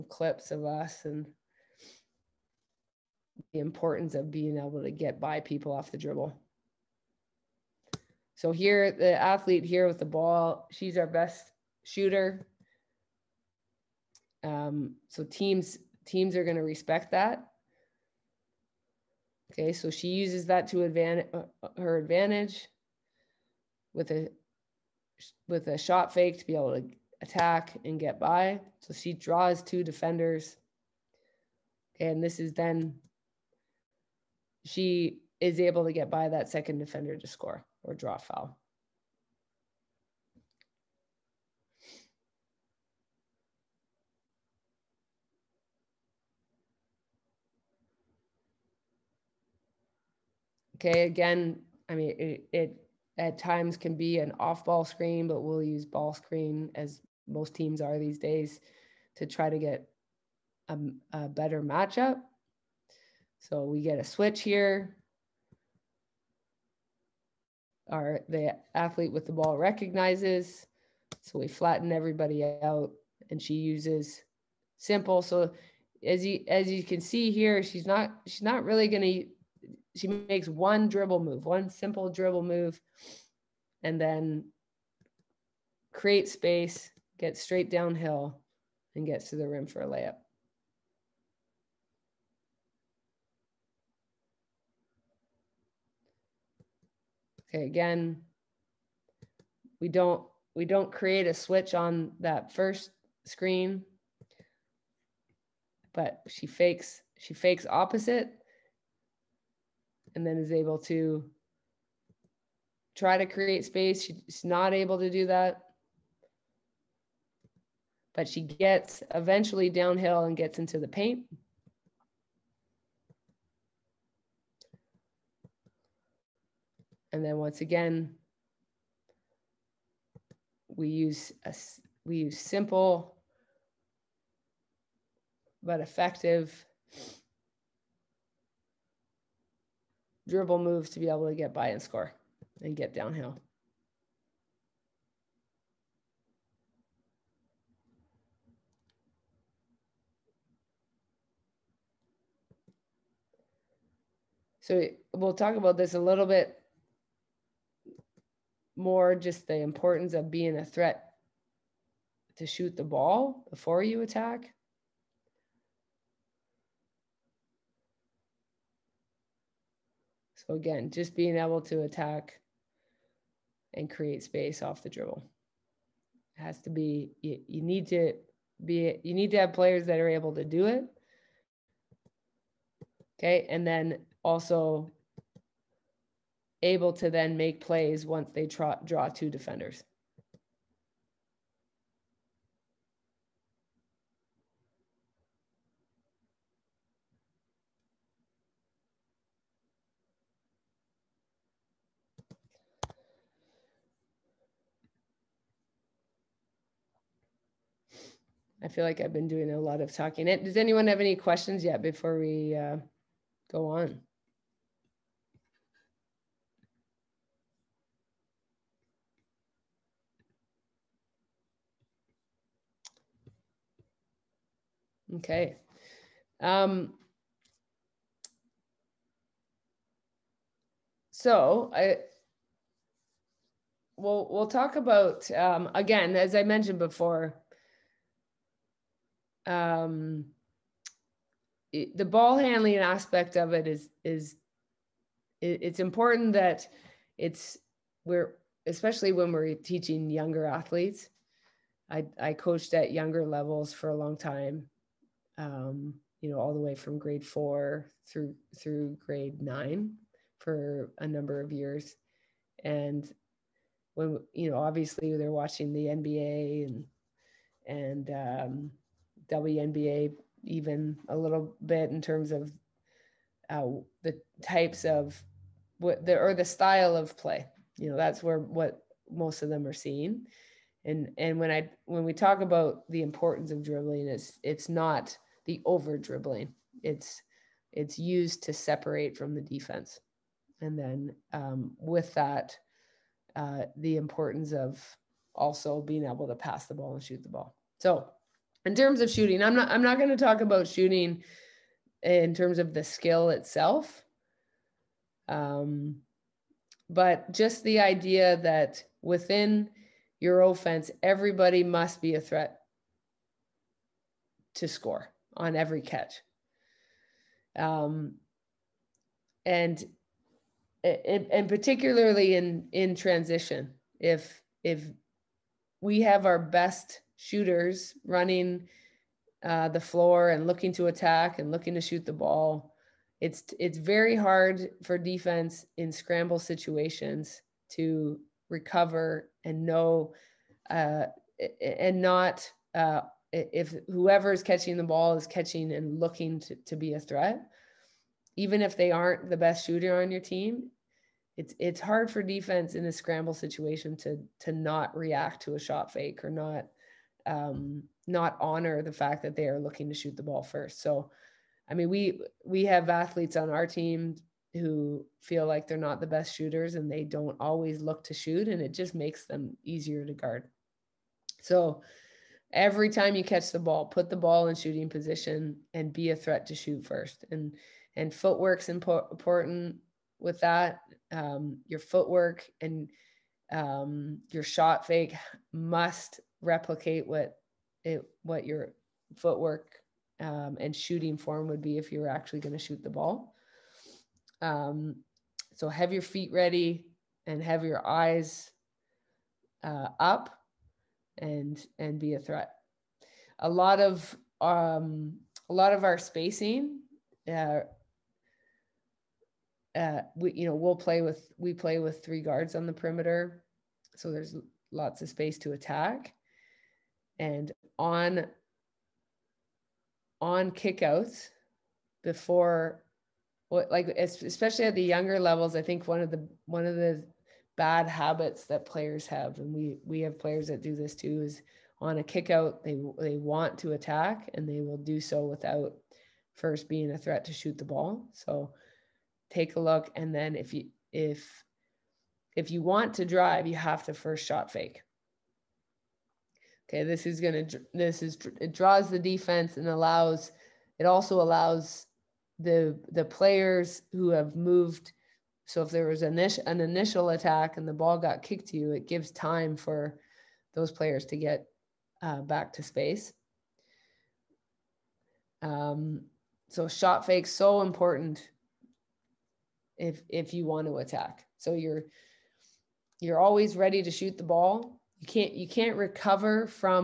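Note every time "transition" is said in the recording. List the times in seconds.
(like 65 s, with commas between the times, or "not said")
322 s.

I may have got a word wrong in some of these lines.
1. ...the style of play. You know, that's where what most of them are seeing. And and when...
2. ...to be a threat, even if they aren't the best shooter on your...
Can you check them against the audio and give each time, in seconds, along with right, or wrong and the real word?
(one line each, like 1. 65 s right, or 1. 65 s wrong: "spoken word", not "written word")
1. 276 s right
2. 346 s right.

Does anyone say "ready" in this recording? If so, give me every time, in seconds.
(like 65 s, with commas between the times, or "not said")
396 s, 473 s.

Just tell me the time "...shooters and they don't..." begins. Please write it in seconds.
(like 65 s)
366 s.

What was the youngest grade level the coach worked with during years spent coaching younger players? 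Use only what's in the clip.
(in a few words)
Grade 4.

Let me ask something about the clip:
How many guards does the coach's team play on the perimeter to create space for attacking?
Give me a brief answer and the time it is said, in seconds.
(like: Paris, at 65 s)
3, at 412 s.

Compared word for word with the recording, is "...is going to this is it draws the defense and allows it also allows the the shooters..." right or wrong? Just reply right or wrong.
wrong.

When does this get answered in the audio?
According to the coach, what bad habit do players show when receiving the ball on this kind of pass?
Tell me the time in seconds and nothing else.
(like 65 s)
432 s.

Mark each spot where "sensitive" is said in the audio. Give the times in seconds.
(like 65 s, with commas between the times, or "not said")
not said.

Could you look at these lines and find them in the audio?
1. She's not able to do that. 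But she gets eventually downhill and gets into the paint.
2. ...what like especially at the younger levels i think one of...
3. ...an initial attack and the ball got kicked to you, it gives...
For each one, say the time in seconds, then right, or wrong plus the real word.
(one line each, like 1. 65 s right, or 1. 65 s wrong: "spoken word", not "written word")
1. 114 s right
2. 423 s right
3. 456 s right.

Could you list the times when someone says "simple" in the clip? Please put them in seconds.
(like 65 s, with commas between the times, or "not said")
74 s, 81 s, 132 s.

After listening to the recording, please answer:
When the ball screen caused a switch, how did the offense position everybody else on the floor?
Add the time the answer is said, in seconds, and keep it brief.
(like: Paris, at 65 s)
Flatten everybody out, at 71 s.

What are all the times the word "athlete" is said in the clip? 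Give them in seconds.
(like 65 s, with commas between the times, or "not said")
9 s, 68 s, 250 s, 362 s.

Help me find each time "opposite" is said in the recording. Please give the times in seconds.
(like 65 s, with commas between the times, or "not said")
107 s.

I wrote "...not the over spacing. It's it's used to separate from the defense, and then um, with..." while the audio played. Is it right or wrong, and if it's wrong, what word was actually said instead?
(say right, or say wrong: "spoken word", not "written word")
wrong: "dribbling", not "spacing".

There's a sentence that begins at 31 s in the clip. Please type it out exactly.
And this is then she is able to get by that second defender to score or draw foul.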